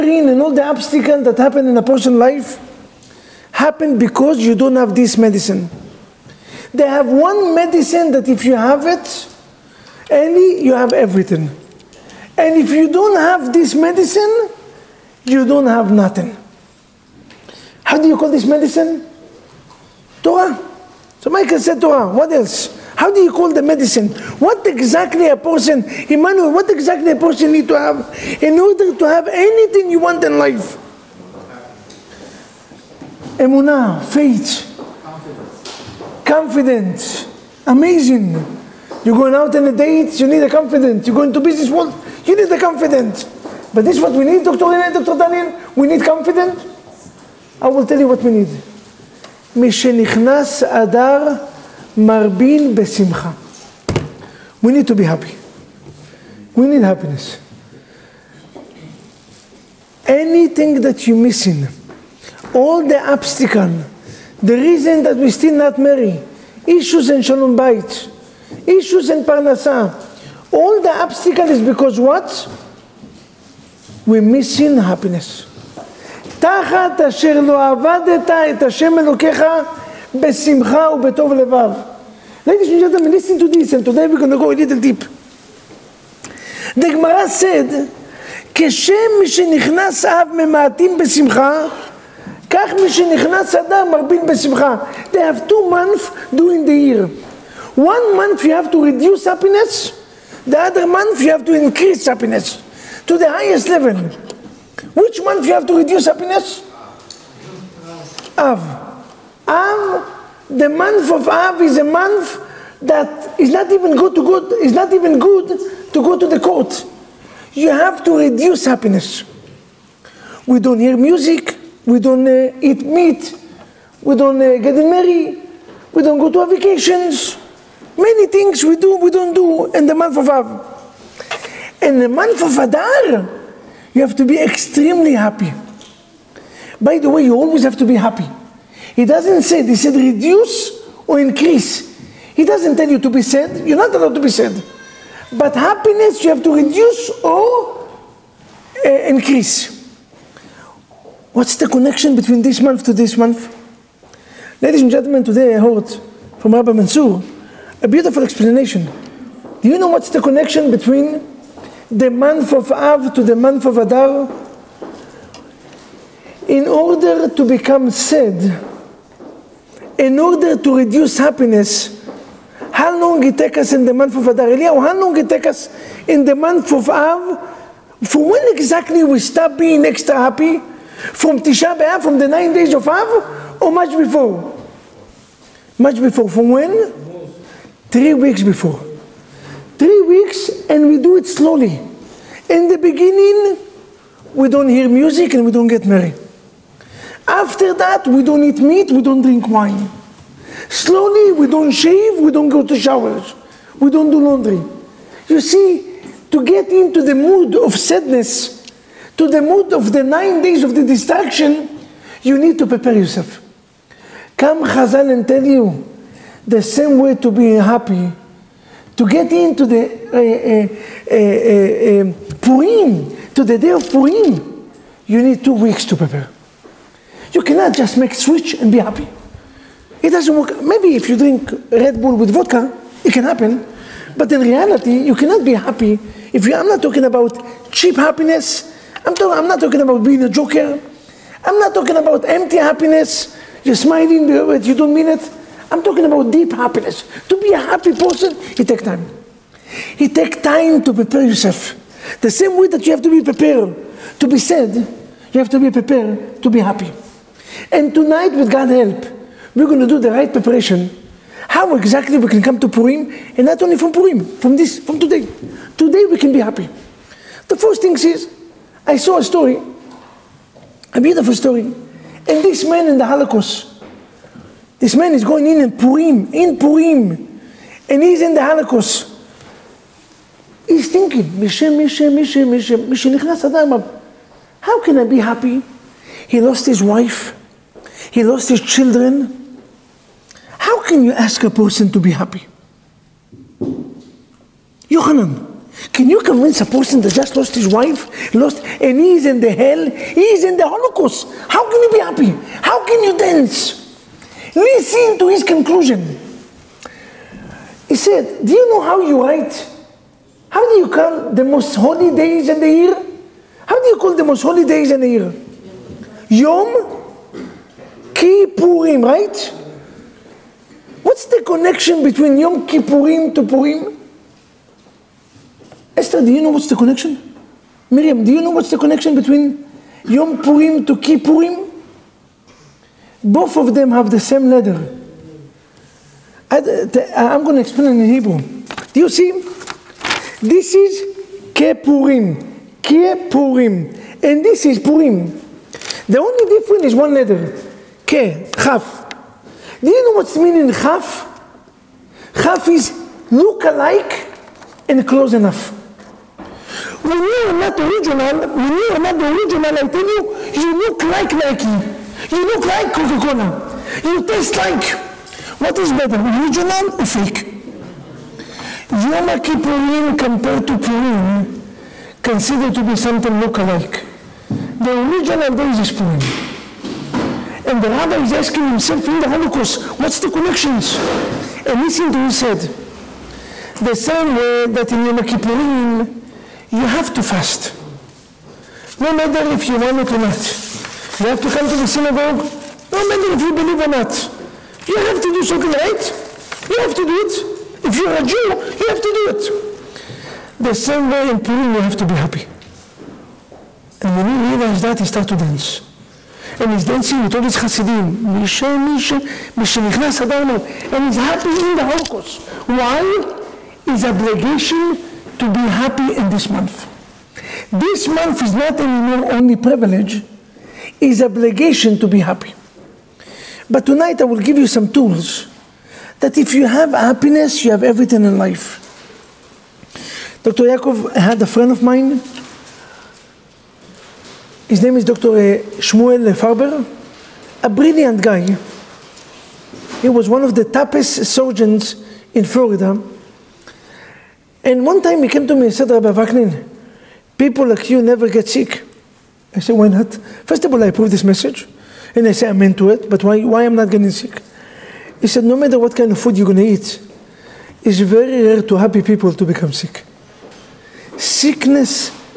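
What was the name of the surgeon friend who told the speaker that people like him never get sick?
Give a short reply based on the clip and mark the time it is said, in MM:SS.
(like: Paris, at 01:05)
Shmuel Farber, at 07:15.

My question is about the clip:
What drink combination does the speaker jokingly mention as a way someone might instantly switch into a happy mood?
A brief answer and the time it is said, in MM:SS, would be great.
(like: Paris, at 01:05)
Red Bull with vodka, at 03:51.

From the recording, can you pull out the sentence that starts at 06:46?
And he's dancing with all his Hasidim.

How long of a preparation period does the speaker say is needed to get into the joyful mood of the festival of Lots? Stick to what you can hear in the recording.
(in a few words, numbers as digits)
Two weeks.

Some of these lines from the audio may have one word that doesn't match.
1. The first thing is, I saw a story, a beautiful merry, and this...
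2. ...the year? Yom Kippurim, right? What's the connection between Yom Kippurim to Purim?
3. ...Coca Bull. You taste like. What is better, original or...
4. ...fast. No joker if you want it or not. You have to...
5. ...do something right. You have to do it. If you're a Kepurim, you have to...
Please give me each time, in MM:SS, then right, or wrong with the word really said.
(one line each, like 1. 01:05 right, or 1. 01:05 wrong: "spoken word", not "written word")
1. 04:27 wrong: "story", not "merry"
2. 05:15 right
3. 06:02 wrong: "Cola", not "Bull"
4. 06:27 wrong: "matter", not "joker"
5. 06:35 wrong: "Jew", not "Kepurim".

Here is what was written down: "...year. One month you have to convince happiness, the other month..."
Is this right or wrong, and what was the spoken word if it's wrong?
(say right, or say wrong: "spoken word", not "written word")
wrong: "reduce", not "convince".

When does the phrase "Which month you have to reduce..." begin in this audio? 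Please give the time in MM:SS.
01:44.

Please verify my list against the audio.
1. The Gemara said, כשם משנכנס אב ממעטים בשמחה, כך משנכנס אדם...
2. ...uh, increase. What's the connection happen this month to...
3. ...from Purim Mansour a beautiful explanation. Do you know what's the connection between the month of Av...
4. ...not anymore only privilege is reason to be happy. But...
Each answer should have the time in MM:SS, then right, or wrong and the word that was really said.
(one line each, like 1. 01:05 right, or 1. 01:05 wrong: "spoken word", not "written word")
1. 01:26 right
2. 02:28 wrong: "between", not "happen"
3. 02:36 wrong: "Rabbi", not "Purim"
4. 06:58 wrong: "obligation", not "reason".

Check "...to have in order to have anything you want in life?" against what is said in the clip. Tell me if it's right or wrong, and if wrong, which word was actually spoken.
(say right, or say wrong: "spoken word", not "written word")
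right.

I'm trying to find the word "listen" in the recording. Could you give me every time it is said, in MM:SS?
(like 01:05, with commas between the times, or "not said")
01:23, 05:04, 06:21.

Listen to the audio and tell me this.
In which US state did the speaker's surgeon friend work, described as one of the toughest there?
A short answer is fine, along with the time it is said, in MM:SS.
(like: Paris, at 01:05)
Florida, at 07:22.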